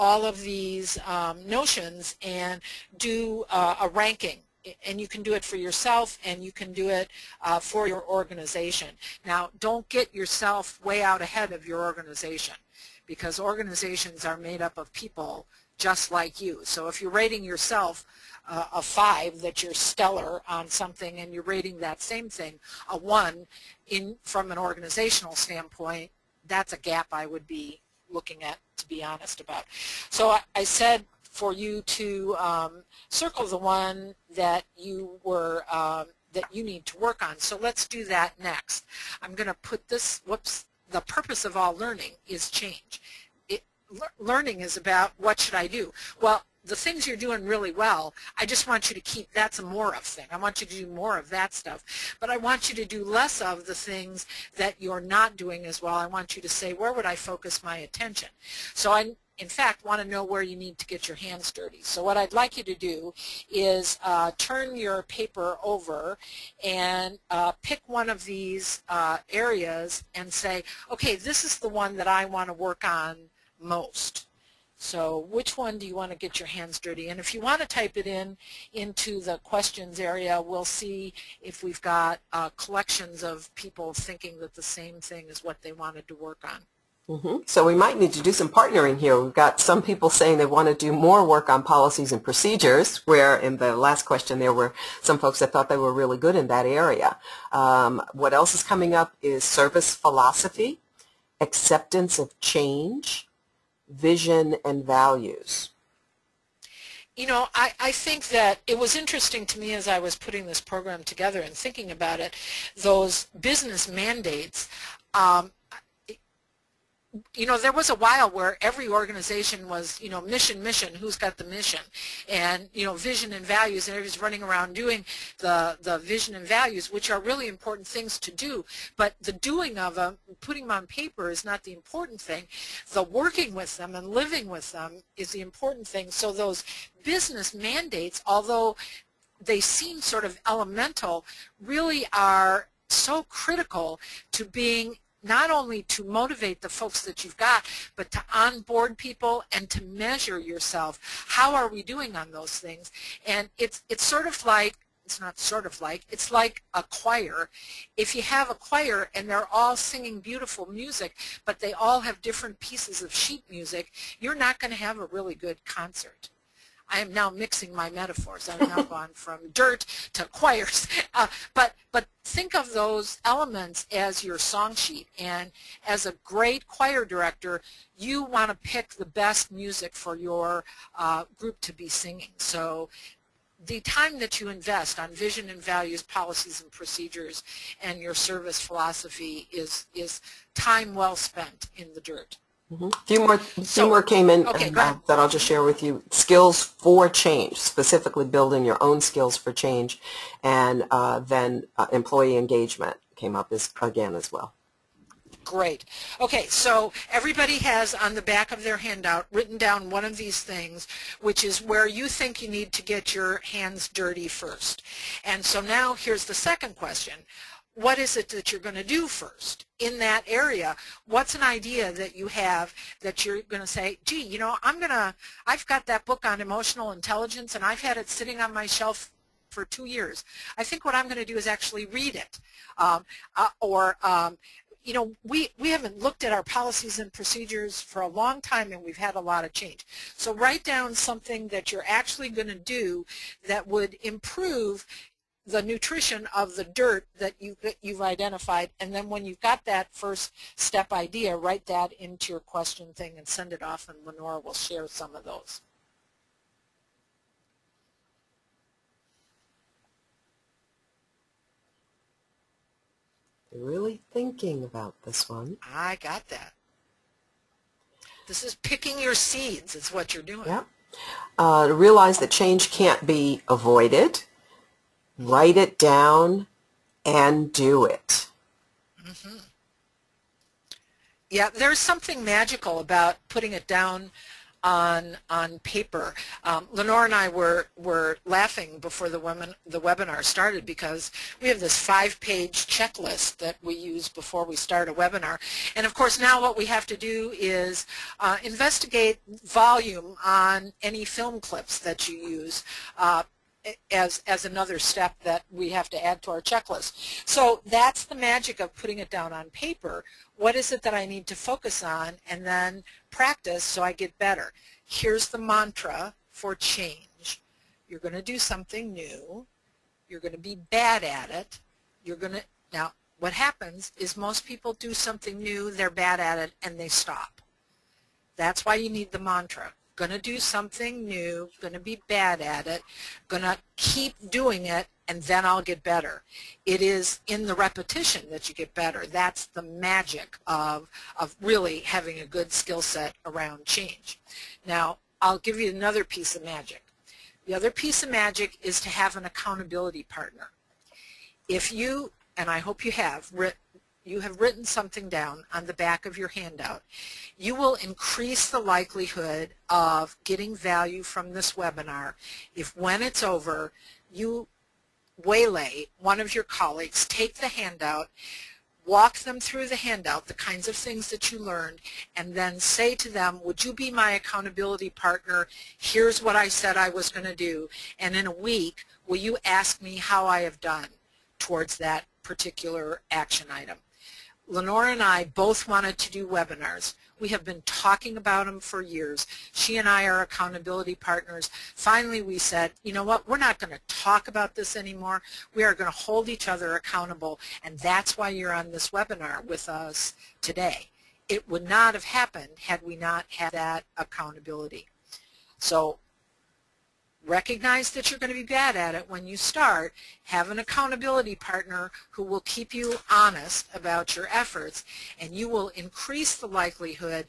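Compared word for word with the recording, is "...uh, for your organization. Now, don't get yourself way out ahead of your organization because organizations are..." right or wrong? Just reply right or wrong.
right.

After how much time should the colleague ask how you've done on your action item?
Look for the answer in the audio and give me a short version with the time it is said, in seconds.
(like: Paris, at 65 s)
a week, at 378 s.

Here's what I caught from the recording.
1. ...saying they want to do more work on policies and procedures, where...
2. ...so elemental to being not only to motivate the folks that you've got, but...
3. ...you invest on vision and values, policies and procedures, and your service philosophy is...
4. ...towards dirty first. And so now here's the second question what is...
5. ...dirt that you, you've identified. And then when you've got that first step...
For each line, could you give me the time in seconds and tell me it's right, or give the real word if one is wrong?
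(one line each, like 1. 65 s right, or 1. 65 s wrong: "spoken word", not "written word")
1. 90 s right
2. 142 s wrong: "critical", not "elemental"
3. 184 s right
4. 213 s wrong: "hands", not "towards"
5. 246 s right.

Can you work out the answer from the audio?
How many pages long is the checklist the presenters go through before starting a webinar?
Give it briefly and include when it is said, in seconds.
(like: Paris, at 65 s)
5, at 291 s.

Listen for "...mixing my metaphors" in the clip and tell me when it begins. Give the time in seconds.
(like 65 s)
167 s.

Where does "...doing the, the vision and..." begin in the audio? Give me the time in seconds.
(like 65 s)
124 s.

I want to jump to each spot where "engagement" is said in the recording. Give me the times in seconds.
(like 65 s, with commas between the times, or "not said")
202 s.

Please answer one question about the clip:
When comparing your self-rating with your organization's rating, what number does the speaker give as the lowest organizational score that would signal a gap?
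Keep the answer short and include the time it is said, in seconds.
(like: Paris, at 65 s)
1, at 22 s.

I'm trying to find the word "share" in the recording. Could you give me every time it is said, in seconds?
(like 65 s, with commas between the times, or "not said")
195 s, 254 s.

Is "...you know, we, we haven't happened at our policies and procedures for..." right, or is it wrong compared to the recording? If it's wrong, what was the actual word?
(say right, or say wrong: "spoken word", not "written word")
wrong: "looked", not "happened".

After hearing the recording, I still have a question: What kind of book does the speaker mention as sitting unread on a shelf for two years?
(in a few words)
emotional intelligence.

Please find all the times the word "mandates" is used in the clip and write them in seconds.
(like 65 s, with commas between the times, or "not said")
114 s, 137 s.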